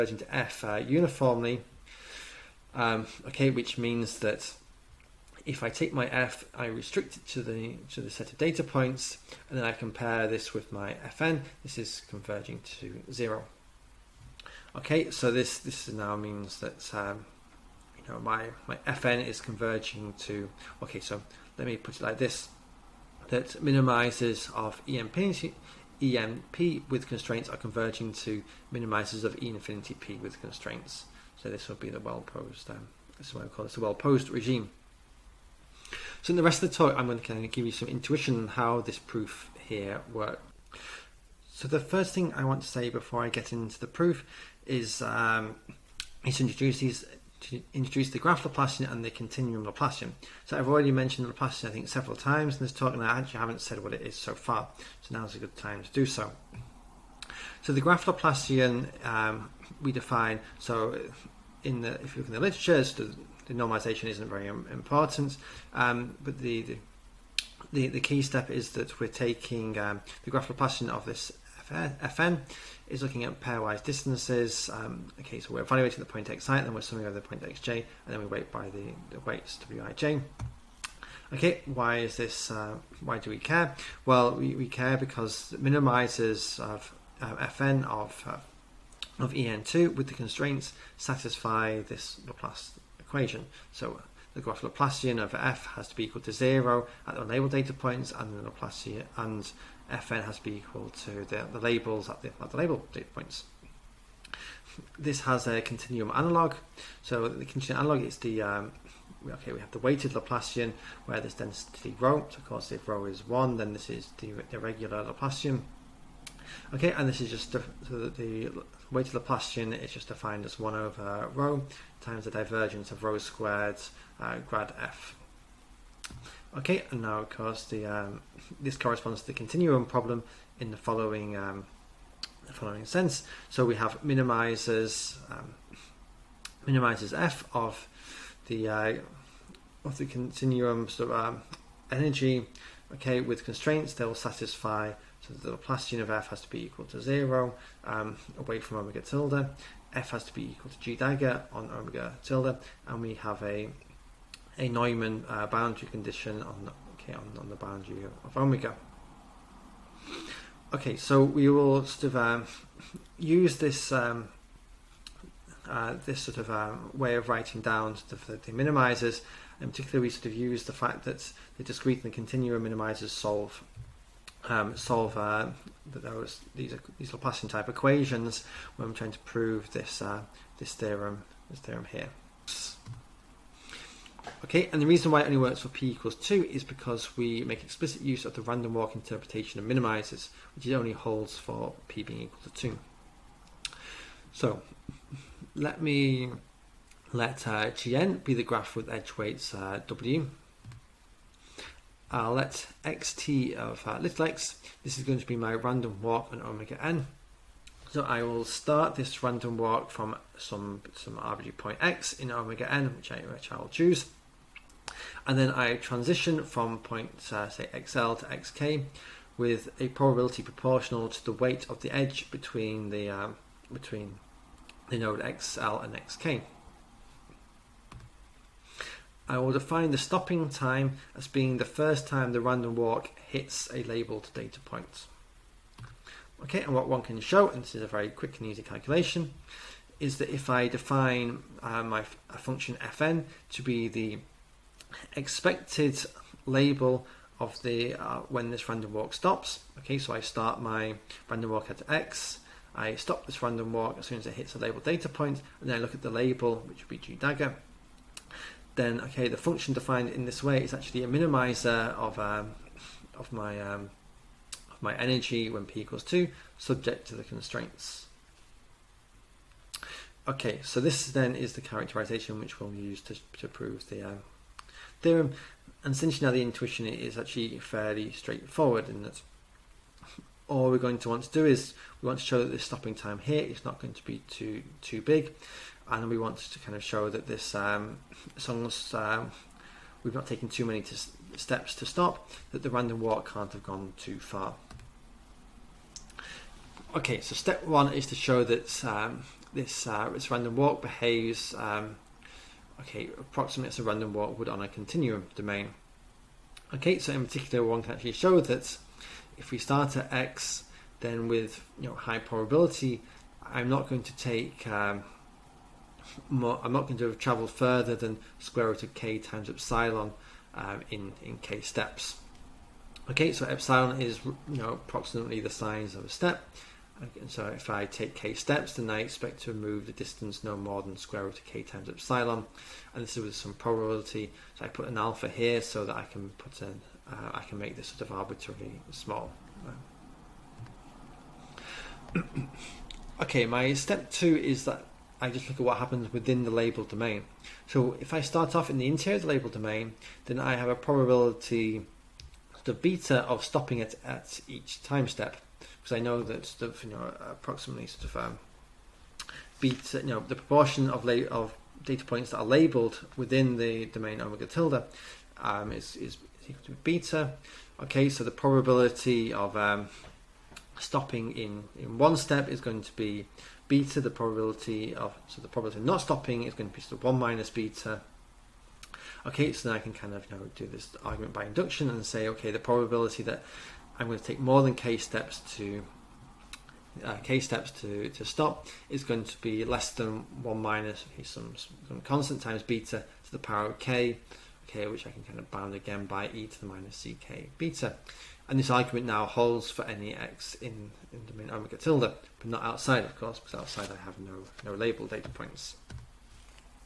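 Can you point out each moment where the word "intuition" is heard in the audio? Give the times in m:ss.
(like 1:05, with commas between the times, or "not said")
0:37, 4:36.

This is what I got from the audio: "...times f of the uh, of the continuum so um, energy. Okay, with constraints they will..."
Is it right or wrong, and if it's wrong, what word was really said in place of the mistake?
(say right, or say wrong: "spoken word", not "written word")
wrong: "minimizes", not "times".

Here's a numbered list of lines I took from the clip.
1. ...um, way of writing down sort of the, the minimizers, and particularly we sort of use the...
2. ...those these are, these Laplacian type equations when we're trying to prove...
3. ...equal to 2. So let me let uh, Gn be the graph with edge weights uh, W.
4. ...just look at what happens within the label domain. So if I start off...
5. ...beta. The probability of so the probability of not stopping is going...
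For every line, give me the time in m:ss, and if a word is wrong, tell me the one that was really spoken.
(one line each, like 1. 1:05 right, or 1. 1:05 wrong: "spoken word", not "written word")
1. 2:46 right
2. 2:55 right
3. 3:12 right
4. 5:45 right
5. 6:13 right.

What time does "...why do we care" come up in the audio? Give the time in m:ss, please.
1:22.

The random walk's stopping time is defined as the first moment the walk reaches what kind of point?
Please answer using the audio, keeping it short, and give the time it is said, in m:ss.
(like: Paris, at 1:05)
a labeled data point, at 3:53.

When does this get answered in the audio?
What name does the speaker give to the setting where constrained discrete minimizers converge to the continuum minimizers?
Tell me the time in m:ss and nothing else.
0:33.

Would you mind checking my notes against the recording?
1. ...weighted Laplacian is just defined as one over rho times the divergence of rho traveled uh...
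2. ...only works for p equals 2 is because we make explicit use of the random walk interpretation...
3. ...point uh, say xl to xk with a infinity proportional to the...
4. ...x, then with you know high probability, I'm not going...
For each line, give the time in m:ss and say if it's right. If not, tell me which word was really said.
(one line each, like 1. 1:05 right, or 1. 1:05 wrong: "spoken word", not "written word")
1. 1:58 wrong: "squared", not "traveled"
2. 3:05 right
3. 3:36 wrong: "probability", not "infinity"
4. 5:10 right.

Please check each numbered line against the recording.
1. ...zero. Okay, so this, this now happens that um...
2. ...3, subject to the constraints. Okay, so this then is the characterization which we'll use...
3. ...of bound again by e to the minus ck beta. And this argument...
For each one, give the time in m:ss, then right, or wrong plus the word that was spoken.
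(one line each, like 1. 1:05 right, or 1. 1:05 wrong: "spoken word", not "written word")
1. 0:13 wrong: "means", not "happens"
2. 4:26 wrong: "2", not "3"
3. 6:35 right.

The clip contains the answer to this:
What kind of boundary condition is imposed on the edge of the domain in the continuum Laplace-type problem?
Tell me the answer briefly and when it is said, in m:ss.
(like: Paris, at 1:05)
Neumann, at 2:34.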